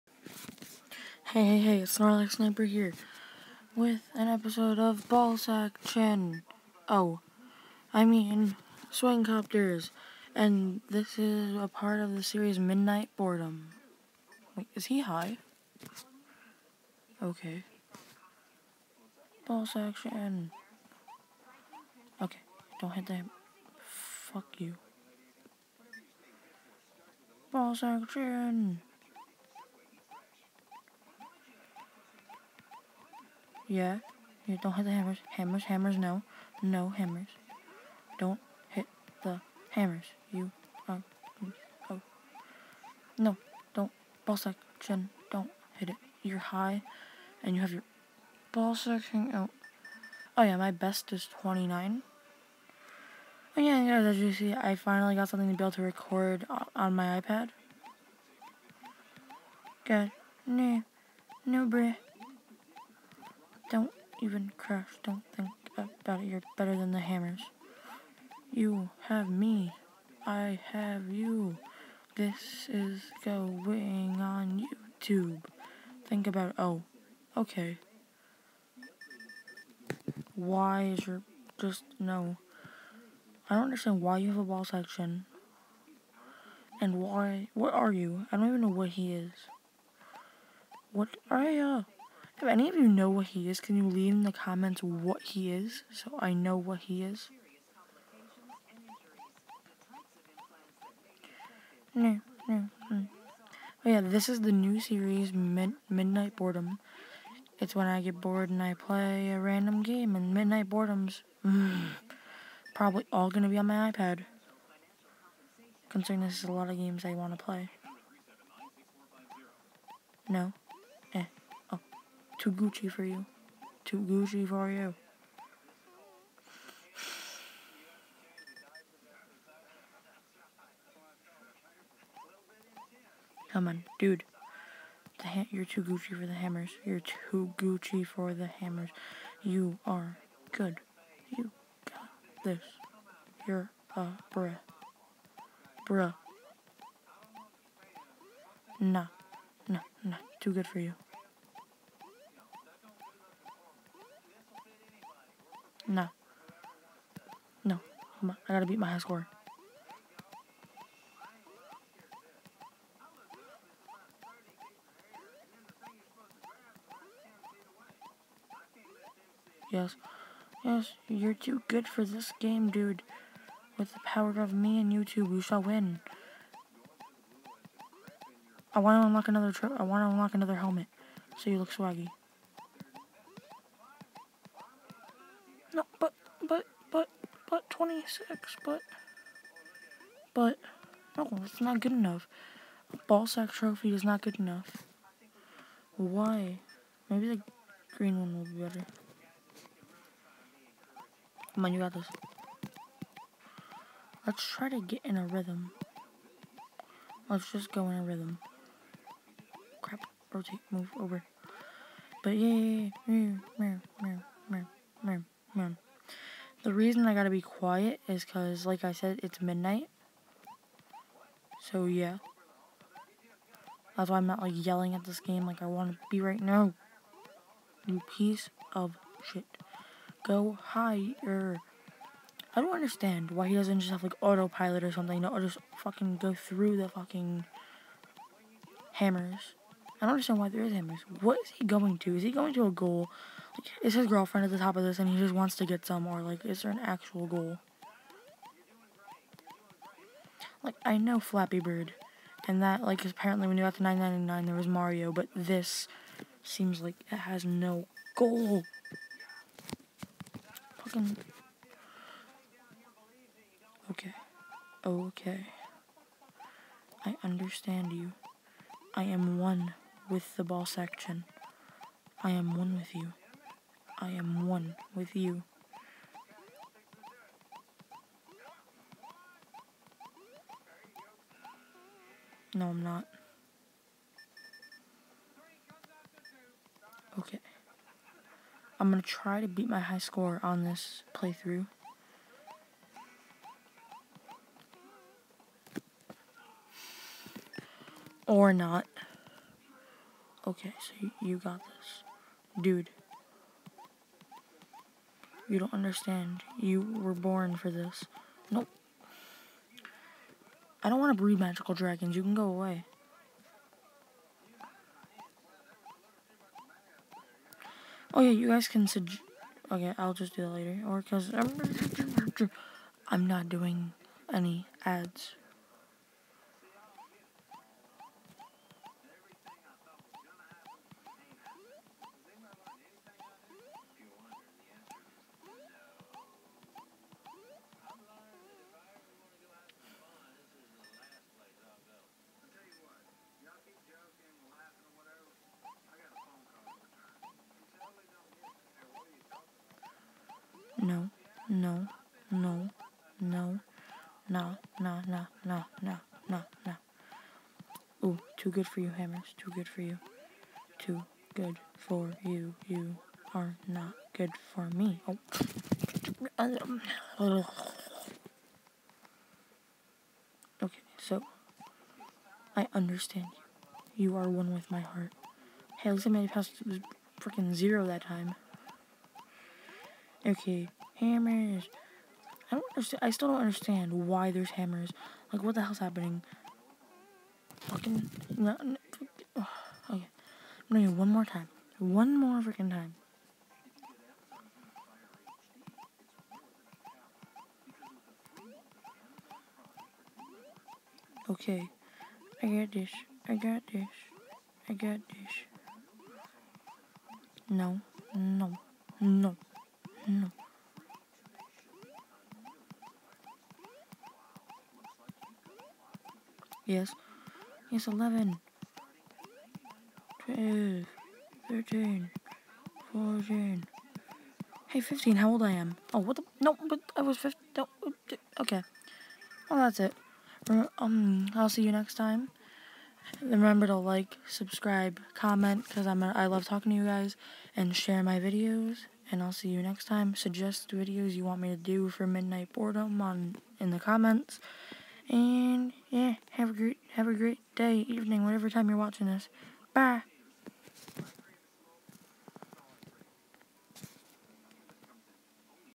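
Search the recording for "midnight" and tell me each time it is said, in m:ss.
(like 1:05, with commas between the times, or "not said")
0:12, 1:45, 1:50, 3:39, 7:22.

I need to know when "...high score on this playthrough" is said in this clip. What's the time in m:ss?
4:49.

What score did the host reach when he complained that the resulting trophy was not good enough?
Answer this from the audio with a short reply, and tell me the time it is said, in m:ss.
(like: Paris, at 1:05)
26, at 3:07.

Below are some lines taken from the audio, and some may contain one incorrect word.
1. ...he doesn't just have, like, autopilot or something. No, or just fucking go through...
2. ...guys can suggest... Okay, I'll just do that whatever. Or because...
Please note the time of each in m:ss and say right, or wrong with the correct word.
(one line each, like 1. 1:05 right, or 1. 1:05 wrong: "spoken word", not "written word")
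1. 3:53 right
2. 5:18 wrong: "later", not "whatever".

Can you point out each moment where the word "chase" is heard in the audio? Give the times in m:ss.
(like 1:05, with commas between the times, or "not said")
not said.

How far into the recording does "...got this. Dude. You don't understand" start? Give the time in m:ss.
5:01.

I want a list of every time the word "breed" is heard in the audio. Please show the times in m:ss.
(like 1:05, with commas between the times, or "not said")
5:11.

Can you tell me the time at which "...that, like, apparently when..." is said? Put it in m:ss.
4:12.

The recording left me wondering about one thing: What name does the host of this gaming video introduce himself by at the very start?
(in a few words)
Snorlax Sniper.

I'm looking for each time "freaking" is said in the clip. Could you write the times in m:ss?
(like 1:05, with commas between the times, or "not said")
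6:17, 6:32.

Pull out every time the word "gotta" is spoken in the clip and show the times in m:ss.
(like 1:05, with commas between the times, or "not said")
2:38, 3:37.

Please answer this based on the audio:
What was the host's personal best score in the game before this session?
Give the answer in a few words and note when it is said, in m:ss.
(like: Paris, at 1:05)
29, at 0:51.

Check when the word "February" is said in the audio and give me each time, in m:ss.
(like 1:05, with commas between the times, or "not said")
not said.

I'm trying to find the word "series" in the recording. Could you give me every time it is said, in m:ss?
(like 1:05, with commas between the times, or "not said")
0:12, 1:44.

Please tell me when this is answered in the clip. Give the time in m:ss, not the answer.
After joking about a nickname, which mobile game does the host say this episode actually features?
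0:08.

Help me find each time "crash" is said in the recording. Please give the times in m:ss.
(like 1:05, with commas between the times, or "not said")
1:04.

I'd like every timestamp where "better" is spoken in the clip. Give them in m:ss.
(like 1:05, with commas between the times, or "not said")
1:06, 3:18.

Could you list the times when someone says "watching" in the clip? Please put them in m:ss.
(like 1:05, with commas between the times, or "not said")
7:28.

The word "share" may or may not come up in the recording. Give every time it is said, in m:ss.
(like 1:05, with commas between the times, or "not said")
7:17.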